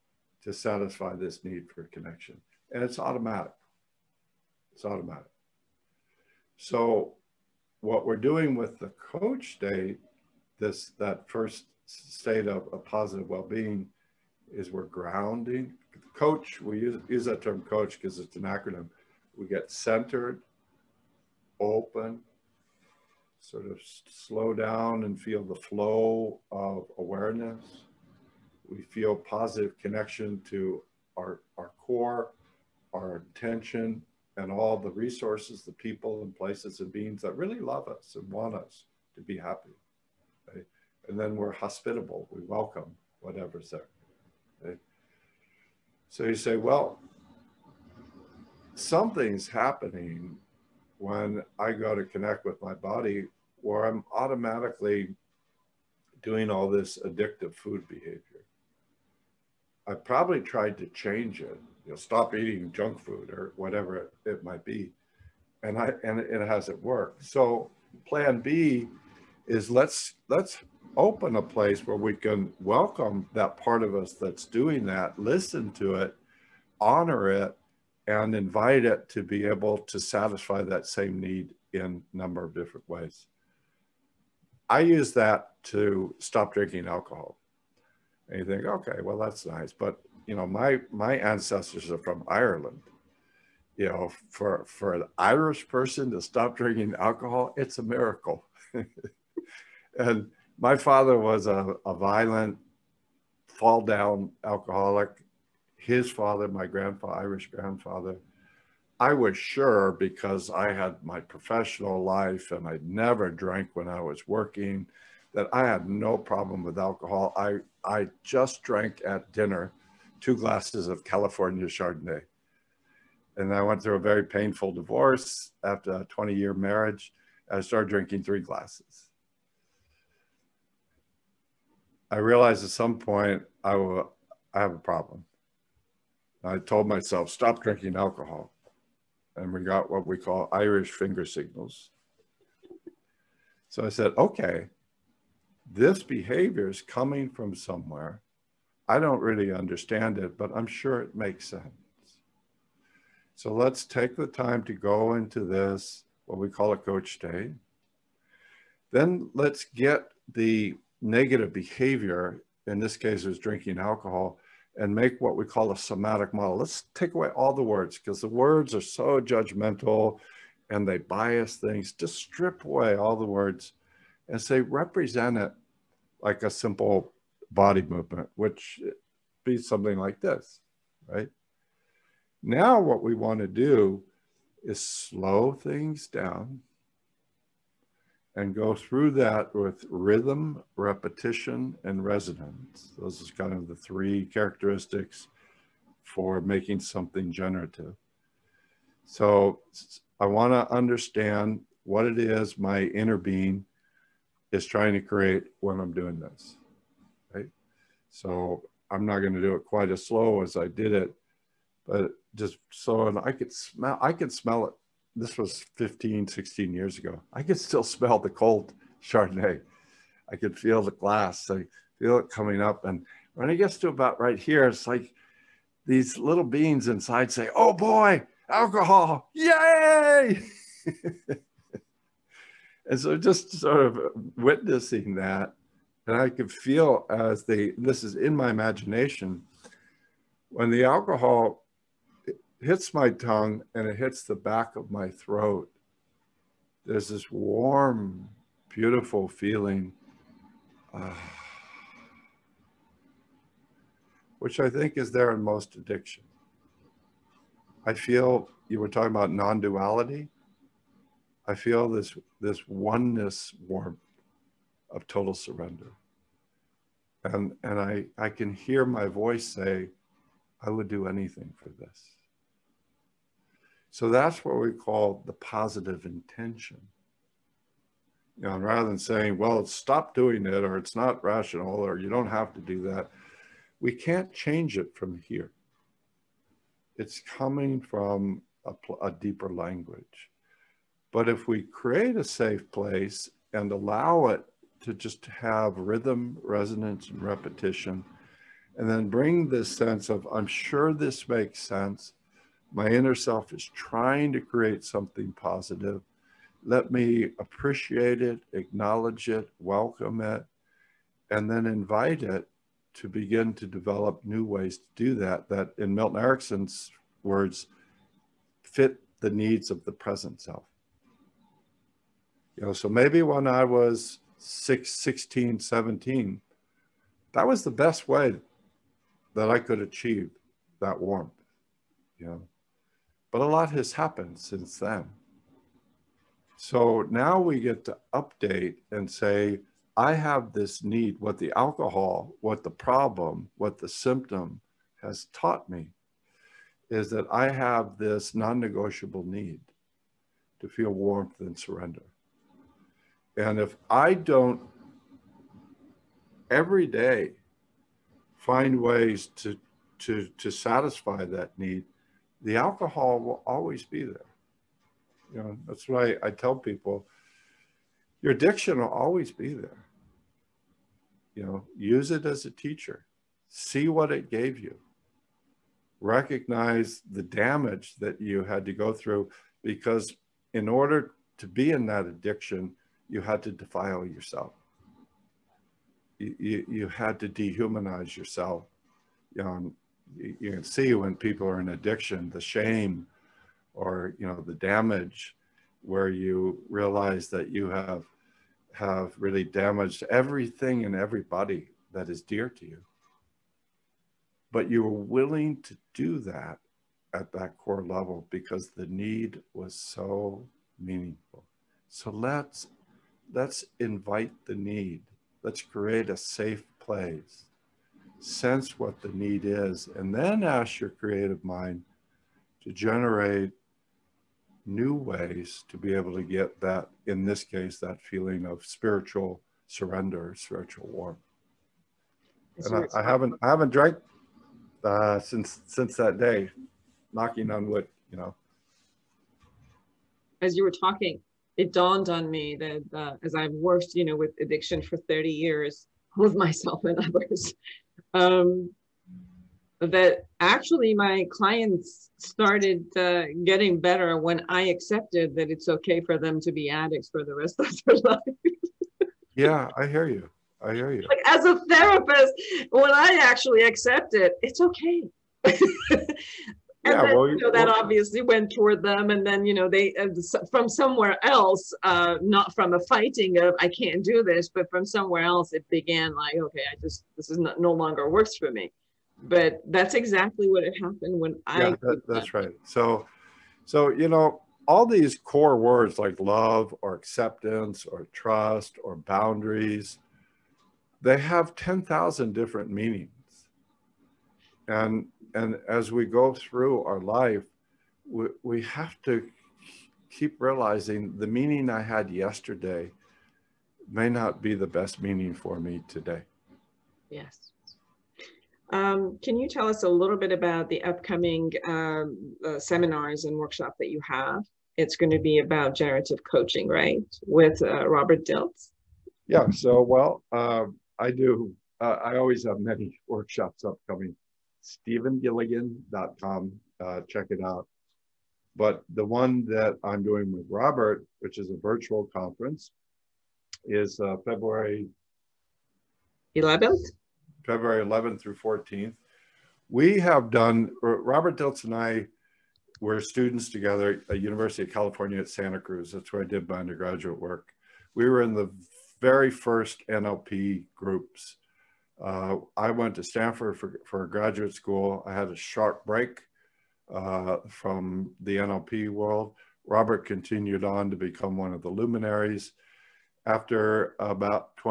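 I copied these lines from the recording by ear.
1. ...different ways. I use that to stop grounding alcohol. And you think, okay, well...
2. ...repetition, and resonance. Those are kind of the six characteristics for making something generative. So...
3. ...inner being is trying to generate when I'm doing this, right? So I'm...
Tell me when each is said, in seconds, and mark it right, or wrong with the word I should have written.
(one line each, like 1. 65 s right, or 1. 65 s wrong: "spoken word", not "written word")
1. 82 s wrong: "drinking", not "grounding"
2. 190 s wrong: "three", not "six"
3. 202 s wrong: "create", not "generate".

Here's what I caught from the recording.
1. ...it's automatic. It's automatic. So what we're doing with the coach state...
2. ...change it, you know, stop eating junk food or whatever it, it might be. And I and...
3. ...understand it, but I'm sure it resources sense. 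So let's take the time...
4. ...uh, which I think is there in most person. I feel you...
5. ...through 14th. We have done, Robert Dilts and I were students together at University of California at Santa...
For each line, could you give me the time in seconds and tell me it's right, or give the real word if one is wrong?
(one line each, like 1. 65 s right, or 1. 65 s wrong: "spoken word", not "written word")
1. 2 s right
2. 60 s right
3. 149 s wrong: "makes", not "resources"
4. 250 s wrong: "addiction", not "person"
5. 538 s right.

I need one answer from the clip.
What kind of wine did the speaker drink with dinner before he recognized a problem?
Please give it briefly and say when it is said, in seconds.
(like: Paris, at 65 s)
California Chardonnay, at 121 s.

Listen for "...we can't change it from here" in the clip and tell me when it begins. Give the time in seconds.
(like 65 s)
283 s.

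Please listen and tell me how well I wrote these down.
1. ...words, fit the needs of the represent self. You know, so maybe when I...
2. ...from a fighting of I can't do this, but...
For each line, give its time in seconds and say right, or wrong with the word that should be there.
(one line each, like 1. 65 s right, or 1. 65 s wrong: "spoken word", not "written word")
1. 317 s wrong: "present", not "represent"
2. 472 s right.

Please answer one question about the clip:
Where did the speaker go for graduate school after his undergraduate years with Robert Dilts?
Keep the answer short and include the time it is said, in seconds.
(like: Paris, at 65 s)
Stanford, at 553 s.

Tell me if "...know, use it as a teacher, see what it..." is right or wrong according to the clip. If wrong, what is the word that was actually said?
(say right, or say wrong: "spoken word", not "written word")
right.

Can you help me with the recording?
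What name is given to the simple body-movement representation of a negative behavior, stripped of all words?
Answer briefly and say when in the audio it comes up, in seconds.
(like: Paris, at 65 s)
somatic model, at 165 s.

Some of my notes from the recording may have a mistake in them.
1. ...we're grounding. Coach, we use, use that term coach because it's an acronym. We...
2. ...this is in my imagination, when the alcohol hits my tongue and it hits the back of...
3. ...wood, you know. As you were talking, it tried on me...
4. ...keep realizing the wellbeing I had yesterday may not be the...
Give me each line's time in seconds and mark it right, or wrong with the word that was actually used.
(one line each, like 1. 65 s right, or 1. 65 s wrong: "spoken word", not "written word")
1. 14 s right
2. 237 s right
3. 437 s wrong: "dawned", not "tried"
4. 500 s wrong: "meaning", not "wellbeing".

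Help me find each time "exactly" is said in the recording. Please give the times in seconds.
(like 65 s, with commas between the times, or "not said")
479 s.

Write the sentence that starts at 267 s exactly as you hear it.
And and I, I can hear my voice say, I would do anything for this.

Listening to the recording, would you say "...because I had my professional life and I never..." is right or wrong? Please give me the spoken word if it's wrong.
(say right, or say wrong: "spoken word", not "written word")
right.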